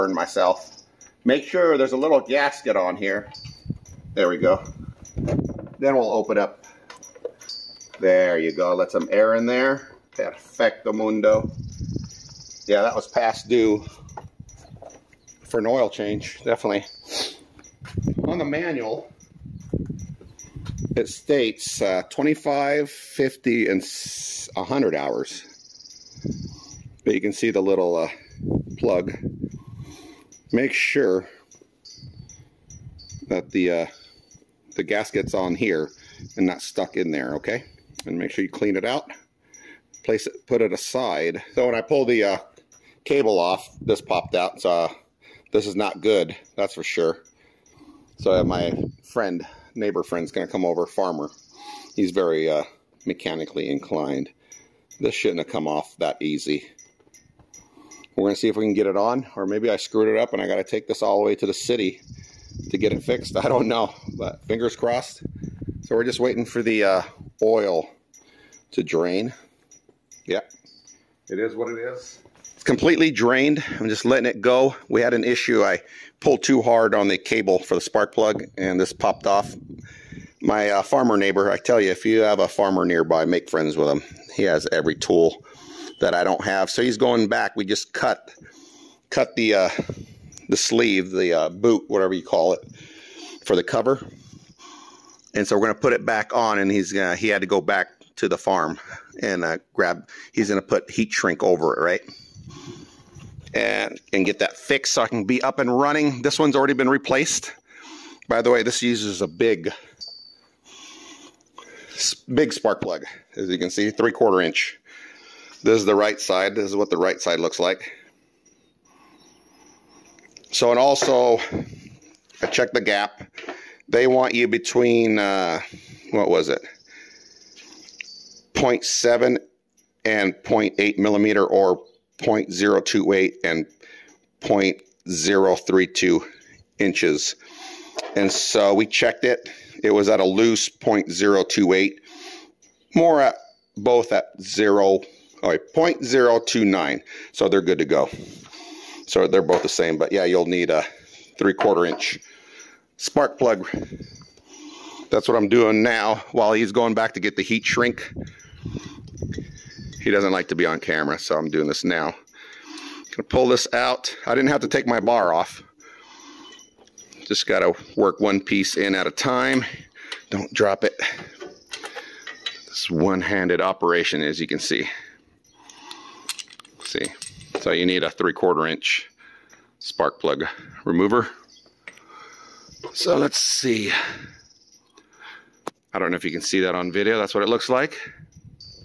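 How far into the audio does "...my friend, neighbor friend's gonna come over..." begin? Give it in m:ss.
0:48.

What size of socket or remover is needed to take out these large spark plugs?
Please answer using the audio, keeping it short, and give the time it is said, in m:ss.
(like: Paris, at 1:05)
3/4 inch, at 2:58.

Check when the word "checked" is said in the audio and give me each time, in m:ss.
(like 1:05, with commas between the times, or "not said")
2:02, 2:18.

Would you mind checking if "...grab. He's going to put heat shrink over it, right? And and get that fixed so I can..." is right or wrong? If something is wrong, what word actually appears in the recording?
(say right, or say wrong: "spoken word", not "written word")
right.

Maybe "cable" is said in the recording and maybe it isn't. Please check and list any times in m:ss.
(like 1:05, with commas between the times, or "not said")
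0:43, 1:17.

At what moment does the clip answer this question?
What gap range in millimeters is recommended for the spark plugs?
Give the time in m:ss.
2:08.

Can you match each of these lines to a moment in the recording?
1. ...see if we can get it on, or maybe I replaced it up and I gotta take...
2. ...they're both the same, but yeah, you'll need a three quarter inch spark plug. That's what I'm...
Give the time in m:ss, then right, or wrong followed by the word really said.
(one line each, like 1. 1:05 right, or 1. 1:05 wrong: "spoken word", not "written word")
1. 0:58 wrong: "screwed", not "replaced"
2. 2:29 right.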